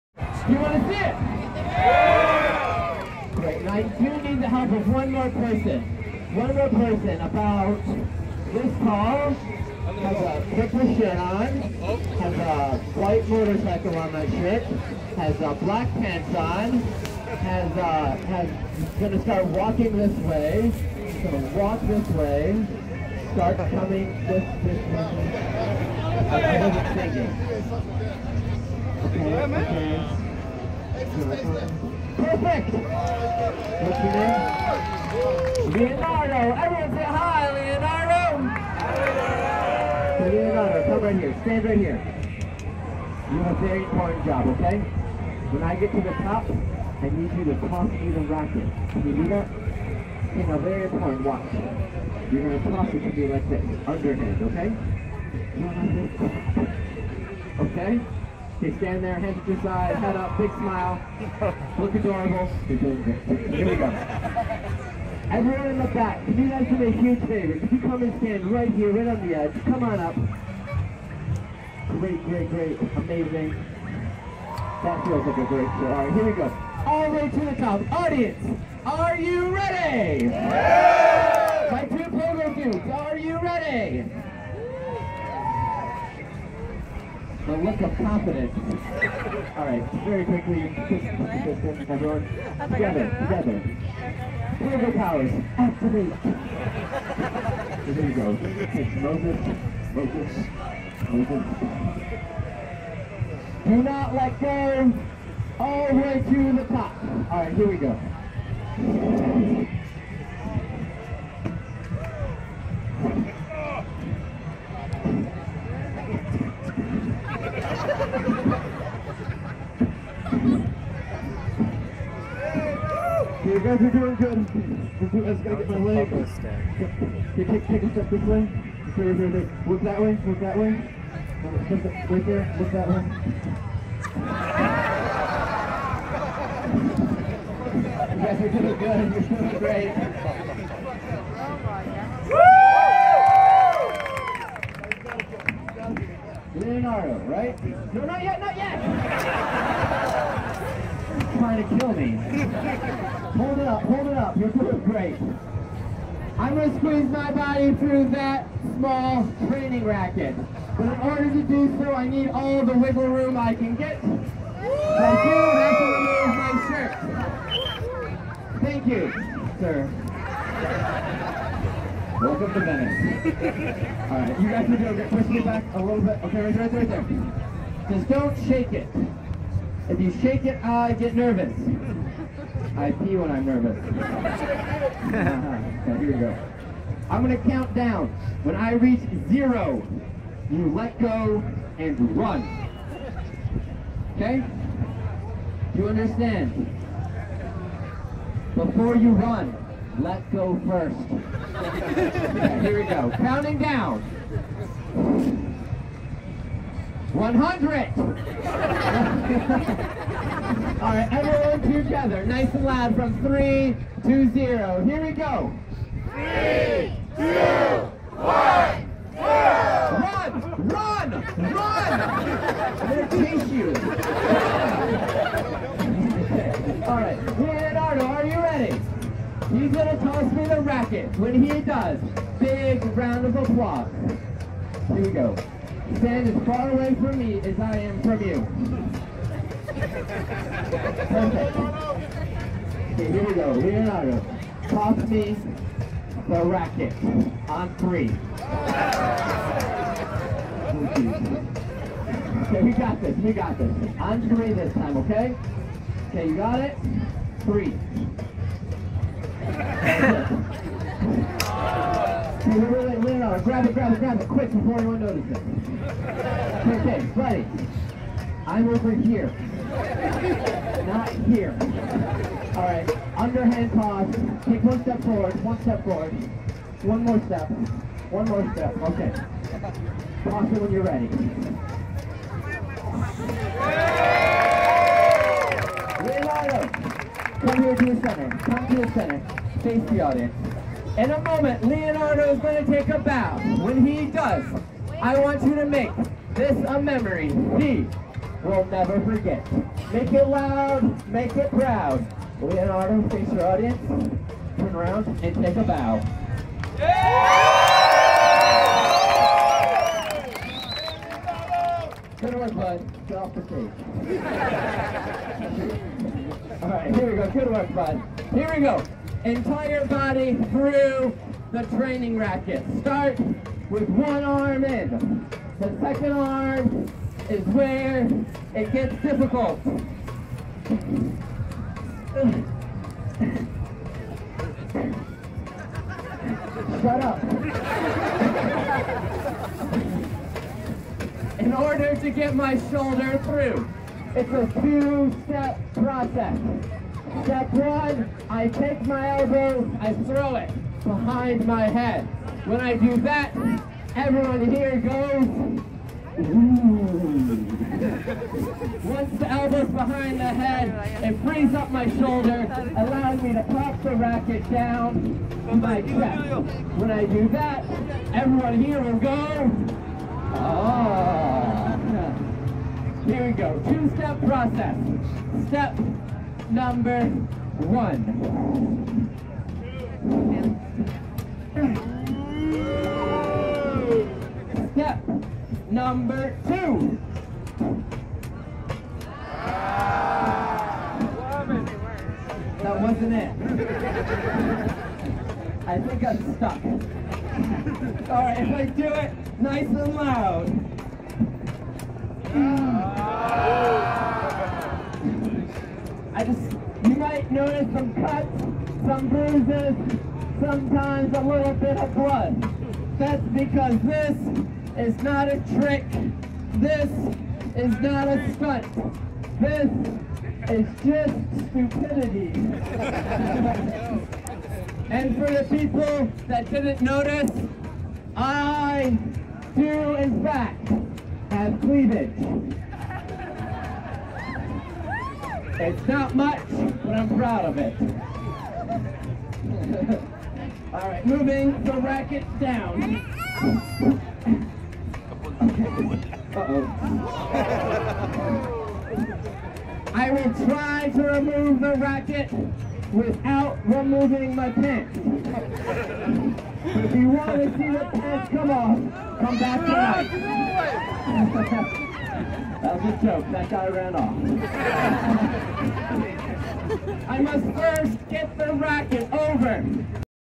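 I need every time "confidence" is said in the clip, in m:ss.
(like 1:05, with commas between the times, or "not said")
1:27.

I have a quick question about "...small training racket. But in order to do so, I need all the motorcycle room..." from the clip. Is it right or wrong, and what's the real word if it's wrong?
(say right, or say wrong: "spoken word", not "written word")
wrong: "wiggle", not "motorcycle".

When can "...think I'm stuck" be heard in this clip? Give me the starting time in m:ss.
6:35.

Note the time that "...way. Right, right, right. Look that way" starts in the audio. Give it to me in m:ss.
2:08.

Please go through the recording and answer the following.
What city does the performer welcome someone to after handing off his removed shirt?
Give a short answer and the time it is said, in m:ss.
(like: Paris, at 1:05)
Venice, at 2:52.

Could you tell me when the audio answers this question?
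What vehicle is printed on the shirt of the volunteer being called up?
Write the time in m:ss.
0:12.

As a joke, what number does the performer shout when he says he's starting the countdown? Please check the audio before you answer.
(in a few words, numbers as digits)
100.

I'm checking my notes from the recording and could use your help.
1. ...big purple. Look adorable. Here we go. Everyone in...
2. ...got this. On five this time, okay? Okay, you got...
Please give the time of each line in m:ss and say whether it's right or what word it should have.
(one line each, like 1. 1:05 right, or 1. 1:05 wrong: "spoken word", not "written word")
1. 1:00 wrong: "smile", not "purple"
2. 4:13 wrong: "three", not "five".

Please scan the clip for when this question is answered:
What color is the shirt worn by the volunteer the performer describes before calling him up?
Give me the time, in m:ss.
0:10.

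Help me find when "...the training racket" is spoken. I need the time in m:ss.
5:21.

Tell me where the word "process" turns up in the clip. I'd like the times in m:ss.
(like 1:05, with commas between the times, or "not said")
5:45, 6:14.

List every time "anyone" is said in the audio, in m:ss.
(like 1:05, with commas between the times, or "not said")
4:24.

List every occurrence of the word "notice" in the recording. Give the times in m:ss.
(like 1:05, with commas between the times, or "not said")
4:24, 6:47, 7:06.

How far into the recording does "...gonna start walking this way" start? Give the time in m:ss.
0:18.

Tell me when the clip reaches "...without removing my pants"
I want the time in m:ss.
7:32.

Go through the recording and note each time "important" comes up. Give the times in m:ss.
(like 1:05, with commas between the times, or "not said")
0:43, 0:50.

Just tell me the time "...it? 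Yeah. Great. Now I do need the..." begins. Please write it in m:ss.
0:00.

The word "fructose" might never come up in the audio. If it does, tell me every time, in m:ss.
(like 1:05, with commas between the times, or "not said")
not said.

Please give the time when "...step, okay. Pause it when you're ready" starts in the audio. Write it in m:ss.
4:38.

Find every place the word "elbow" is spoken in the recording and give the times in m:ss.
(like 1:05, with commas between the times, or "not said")
5:49, 5:59.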